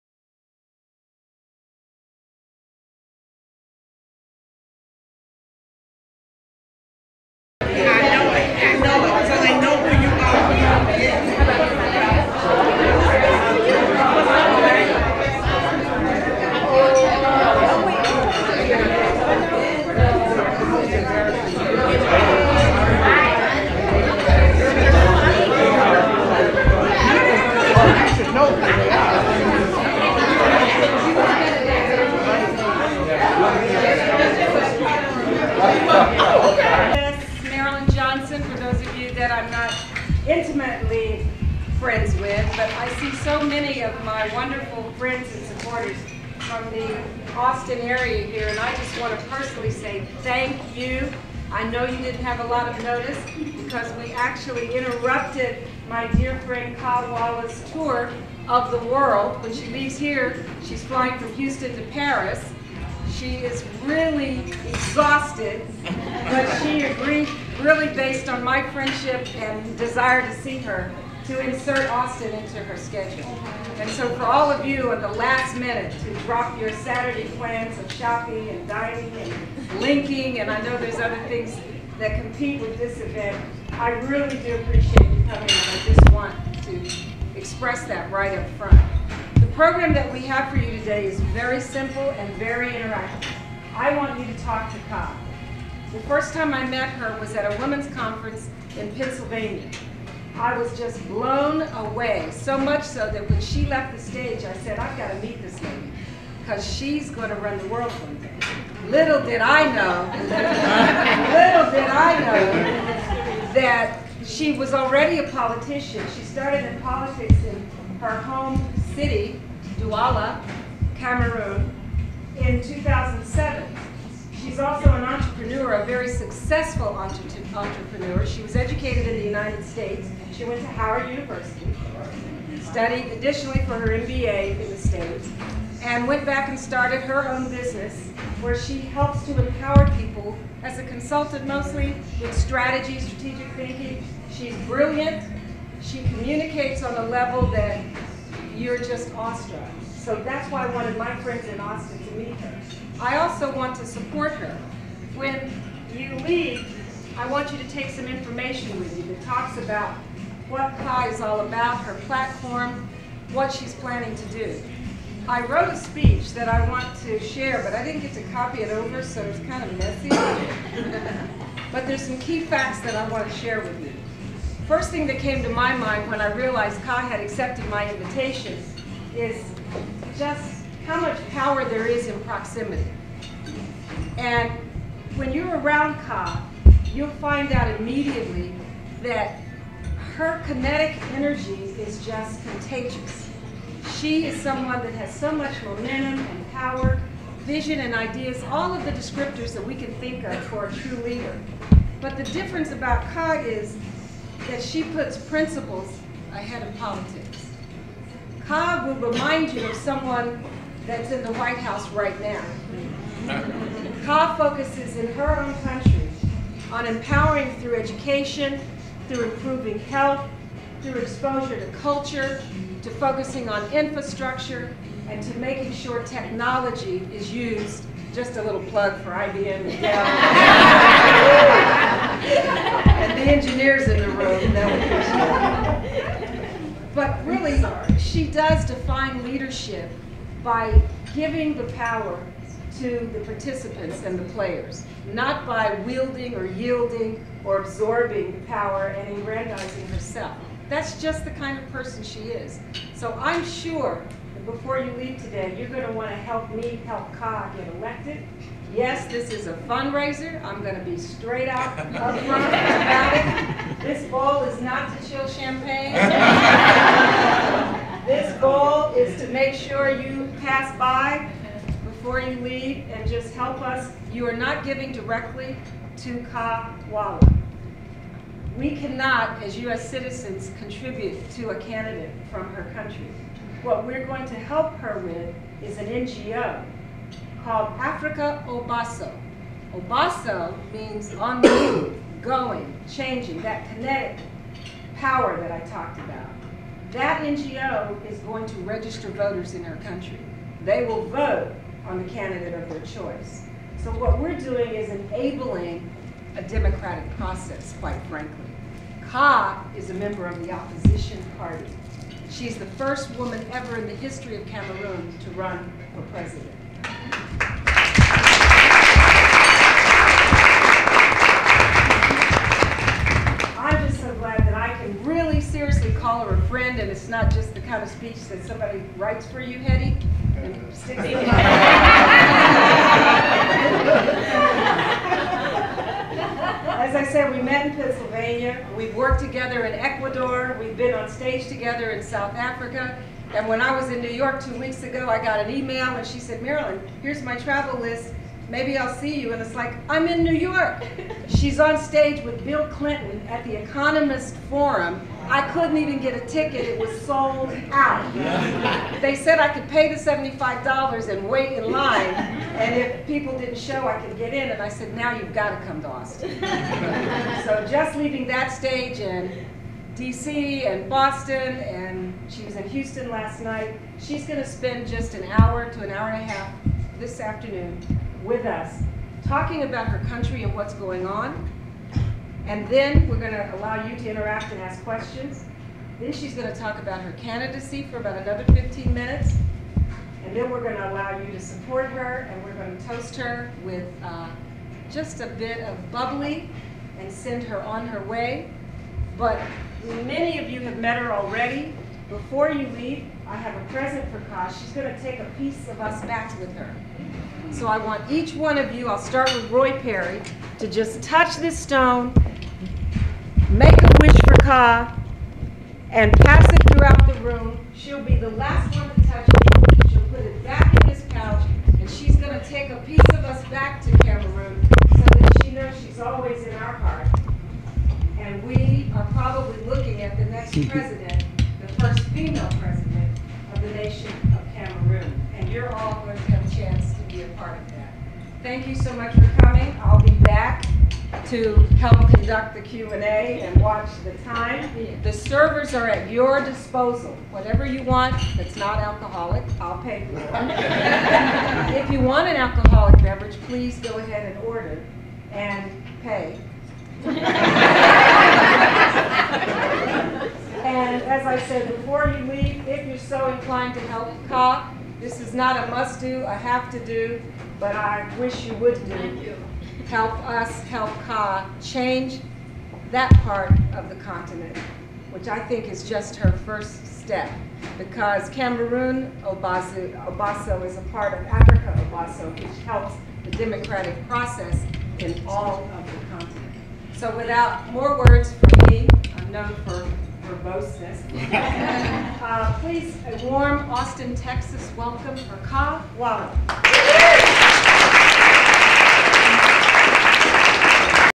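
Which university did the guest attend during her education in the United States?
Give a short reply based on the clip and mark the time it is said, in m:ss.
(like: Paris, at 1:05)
Howard University, at 2:10.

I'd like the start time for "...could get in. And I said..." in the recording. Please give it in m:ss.
6:04.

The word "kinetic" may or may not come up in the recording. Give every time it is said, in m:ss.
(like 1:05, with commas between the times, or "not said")
3:10, 4:53.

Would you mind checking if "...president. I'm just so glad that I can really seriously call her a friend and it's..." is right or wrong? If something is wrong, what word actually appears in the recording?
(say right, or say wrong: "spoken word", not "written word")
right.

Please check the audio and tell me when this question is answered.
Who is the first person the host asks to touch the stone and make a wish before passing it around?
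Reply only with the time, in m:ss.
6:49.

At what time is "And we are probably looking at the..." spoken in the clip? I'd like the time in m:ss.
7:08.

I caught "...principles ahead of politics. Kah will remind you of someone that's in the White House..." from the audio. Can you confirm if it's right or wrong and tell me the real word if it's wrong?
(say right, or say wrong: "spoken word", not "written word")
right.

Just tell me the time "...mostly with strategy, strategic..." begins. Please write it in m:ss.
2:21.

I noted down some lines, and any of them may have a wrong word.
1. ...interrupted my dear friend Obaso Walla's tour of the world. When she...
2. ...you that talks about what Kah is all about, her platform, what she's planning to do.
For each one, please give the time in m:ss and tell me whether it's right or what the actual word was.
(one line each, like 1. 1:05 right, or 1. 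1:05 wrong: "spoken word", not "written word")
1. 0:54 wrong: "Kah", not "Obaso"
2. 2:38 right.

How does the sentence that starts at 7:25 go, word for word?
The servers are at your disposal.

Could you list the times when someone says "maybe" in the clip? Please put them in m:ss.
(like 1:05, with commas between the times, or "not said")
5:48.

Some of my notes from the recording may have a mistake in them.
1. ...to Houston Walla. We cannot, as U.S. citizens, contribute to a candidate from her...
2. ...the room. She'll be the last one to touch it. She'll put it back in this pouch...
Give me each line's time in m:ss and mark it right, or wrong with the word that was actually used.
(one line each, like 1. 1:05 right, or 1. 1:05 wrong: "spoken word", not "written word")
1. 4:35 wrong: "Kah", not "Houston"
2. 6:57 right.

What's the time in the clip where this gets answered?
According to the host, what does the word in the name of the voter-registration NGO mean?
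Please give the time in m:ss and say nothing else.
4:51.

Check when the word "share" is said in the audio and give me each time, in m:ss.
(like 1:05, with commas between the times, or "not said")
2:47, 2:53.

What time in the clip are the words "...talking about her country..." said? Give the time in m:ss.
6:19.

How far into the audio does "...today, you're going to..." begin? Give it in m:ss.
4:15.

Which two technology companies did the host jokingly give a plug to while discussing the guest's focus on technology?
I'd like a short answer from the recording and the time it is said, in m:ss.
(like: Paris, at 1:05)
IBM and Dell, at 3:49.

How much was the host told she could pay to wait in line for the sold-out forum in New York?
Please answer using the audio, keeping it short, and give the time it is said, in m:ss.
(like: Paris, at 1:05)
$75, at 5:59.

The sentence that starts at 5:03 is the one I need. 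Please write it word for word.
So what we're doing is enabling a democratic process, quite frankly.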